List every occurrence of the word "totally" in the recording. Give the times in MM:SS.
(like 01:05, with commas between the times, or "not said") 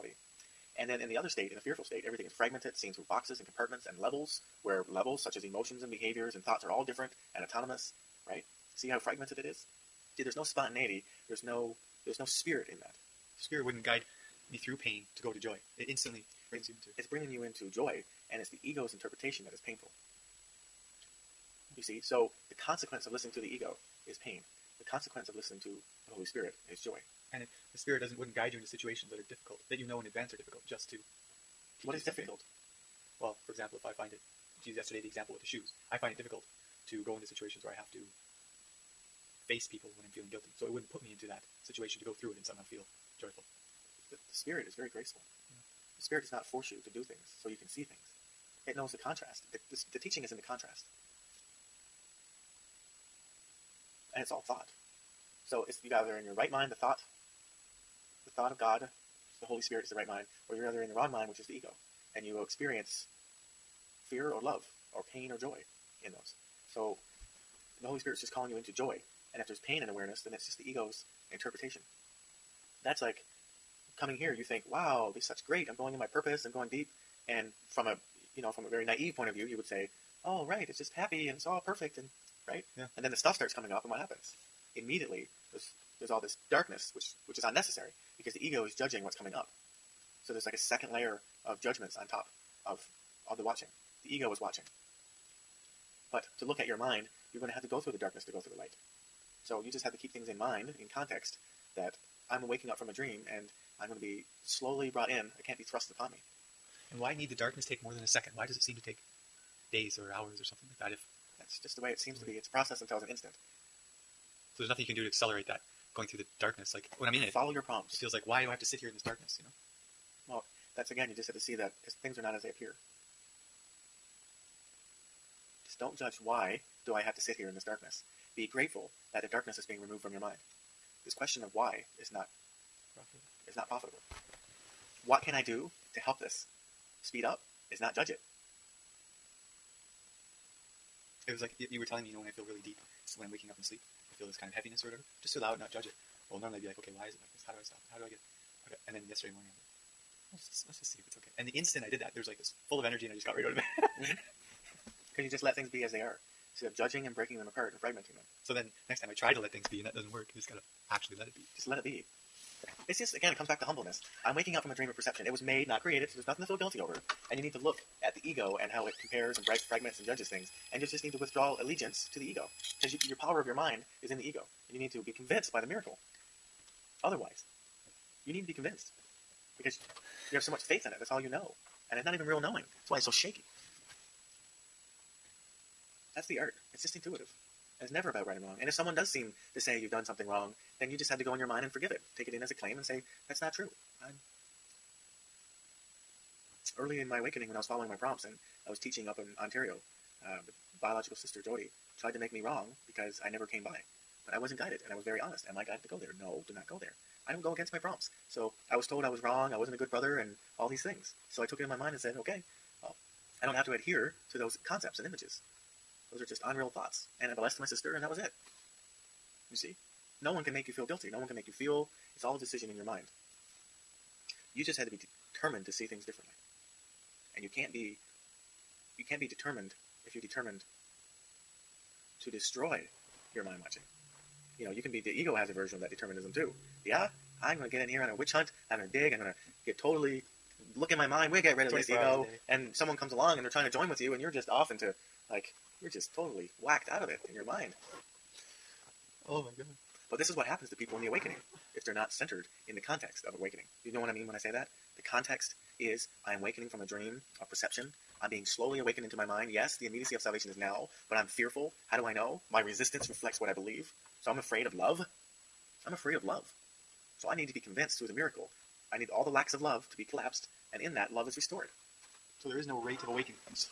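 03:59, 04:06.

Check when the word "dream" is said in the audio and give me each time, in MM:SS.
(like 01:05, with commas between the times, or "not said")
01:42, 02:44, 04:16.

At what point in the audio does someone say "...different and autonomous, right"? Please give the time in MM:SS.
00:06.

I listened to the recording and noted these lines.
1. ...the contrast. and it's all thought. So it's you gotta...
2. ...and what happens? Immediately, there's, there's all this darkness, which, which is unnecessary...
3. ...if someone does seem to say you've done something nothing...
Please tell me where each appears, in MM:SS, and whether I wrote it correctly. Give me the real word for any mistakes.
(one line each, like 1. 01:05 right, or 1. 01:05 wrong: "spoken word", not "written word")
1. 00:50 right
2. 01:23 right
3. 03:08 wrong: "wrong", not "nothing".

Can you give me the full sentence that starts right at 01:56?
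Like when I'm in it, follow your prompts.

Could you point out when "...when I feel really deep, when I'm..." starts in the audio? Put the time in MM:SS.
02:22.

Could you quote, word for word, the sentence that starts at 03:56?
Yeah, I'm going to get in here on a witch hunt.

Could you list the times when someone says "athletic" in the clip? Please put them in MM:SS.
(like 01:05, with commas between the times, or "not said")
not said.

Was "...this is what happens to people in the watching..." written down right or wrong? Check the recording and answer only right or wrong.
wrong.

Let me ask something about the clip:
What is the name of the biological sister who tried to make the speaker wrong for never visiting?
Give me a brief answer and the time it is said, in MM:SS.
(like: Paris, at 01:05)
Jody, at 03:21.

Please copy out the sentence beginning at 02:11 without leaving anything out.
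This question of why is not is not profitable.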